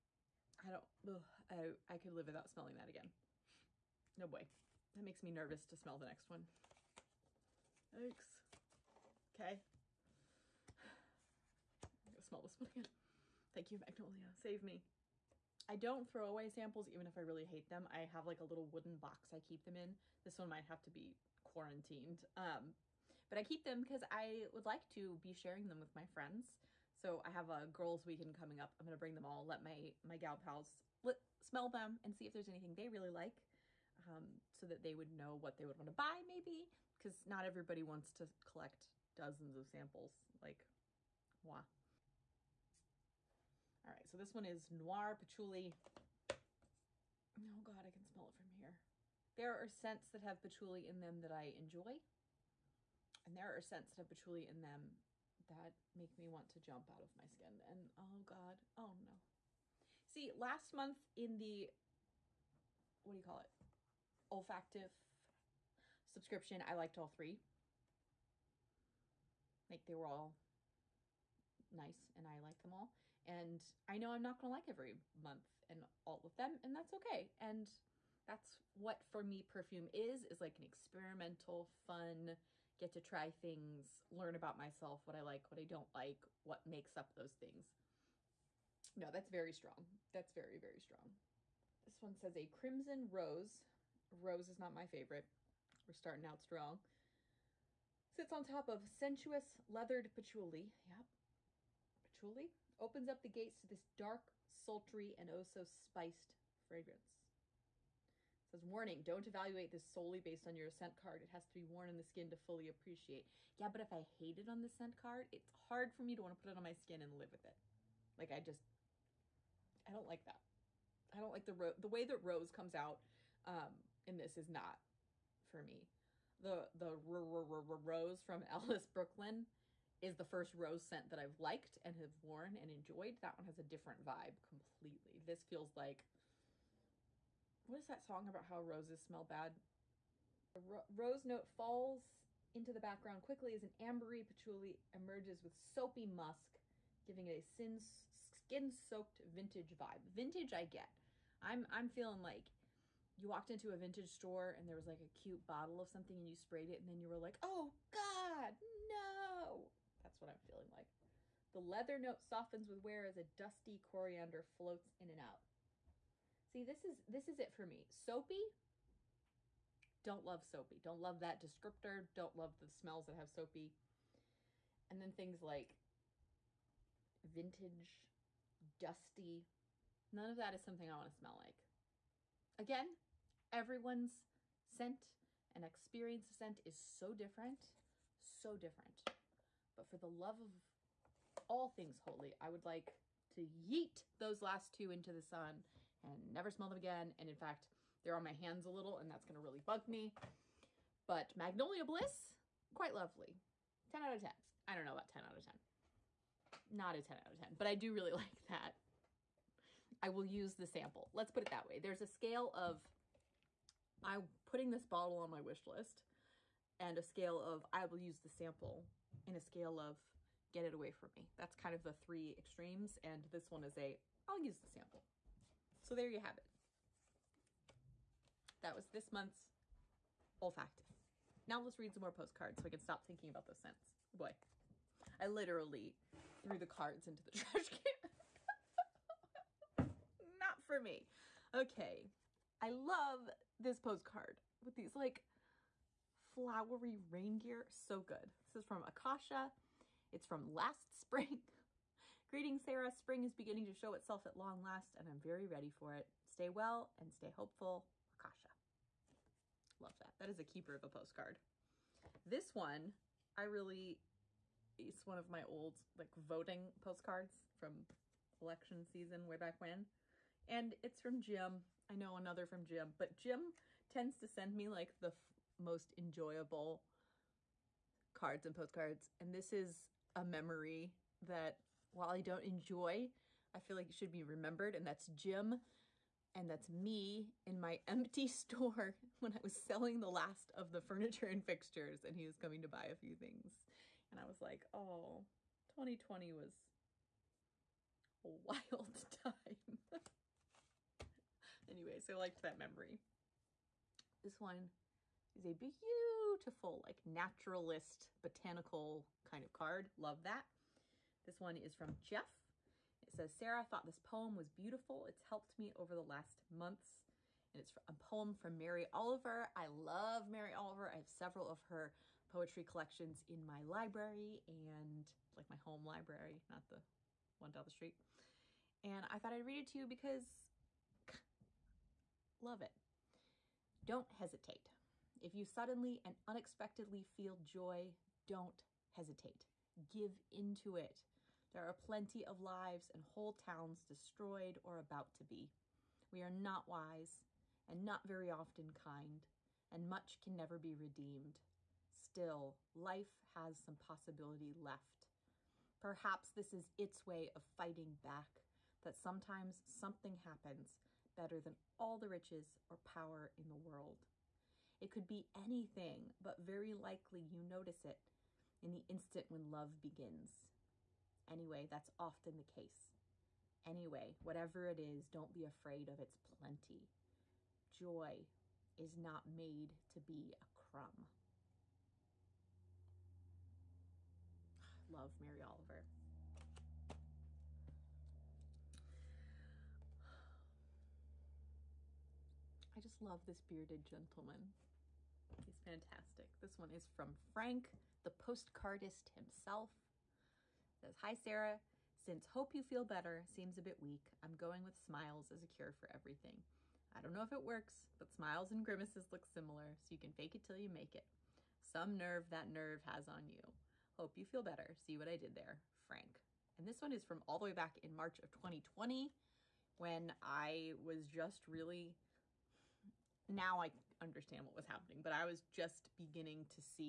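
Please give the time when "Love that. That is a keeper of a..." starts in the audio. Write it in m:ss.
4:19.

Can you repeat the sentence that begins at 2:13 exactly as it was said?
That one has a different vibe completely.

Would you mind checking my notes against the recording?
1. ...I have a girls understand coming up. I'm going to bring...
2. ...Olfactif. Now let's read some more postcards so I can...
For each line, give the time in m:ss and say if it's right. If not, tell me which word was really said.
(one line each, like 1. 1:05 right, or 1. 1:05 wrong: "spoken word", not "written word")
1. 0:27 wrong: "weekend", not "understand"
2. 3:50 right.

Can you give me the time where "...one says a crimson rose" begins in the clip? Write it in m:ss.
1:32.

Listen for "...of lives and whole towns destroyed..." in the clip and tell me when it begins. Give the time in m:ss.
5:42.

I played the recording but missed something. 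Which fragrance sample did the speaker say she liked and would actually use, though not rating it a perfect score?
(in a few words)
Magnolia Bliss.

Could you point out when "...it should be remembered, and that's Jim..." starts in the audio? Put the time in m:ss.
4:43.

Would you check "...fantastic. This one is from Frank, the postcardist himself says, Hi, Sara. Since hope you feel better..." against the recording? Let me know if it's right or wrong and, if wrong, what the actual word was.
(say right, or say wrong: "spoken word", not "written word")
right.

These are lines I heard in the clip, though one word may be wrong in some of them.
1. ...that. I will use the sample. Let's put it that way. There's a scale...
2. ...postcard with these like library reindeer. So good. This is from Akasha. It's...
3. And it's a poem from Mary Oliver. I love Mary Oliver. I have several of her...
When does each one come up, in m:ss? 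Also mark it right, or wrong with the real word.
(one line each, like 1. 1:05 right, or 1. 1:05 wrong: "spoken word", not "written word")
1. 3:28 right
2. 4:03 wrong: "flowery", not "library"
3. 5:17 right.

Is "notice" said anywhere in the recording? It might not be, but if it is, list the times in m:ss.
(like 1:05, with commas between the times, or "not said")
6:07.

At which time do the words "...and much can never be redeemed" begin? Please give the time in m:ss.
5:49.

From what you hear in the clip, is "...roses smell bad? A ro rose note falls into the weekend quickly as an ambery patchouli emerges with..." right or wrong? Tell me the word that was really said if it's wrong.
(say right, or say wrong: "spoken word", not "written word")
wrong: "background", not "weekend".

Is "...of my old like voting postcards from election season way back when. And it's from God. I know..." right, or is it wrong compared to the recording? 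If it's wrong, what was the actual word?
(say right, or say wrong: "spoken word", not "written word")
wrong: "Jim", not "God".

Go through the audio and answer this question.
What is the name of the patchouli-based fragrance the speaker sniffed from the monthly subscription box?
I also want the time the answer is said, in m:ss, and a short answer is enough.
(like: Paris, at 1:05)
Noir Patchouli, at 0:44.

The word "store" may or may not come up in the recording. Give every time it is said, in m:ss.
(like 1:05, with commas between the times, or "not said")
2:34, 4:48.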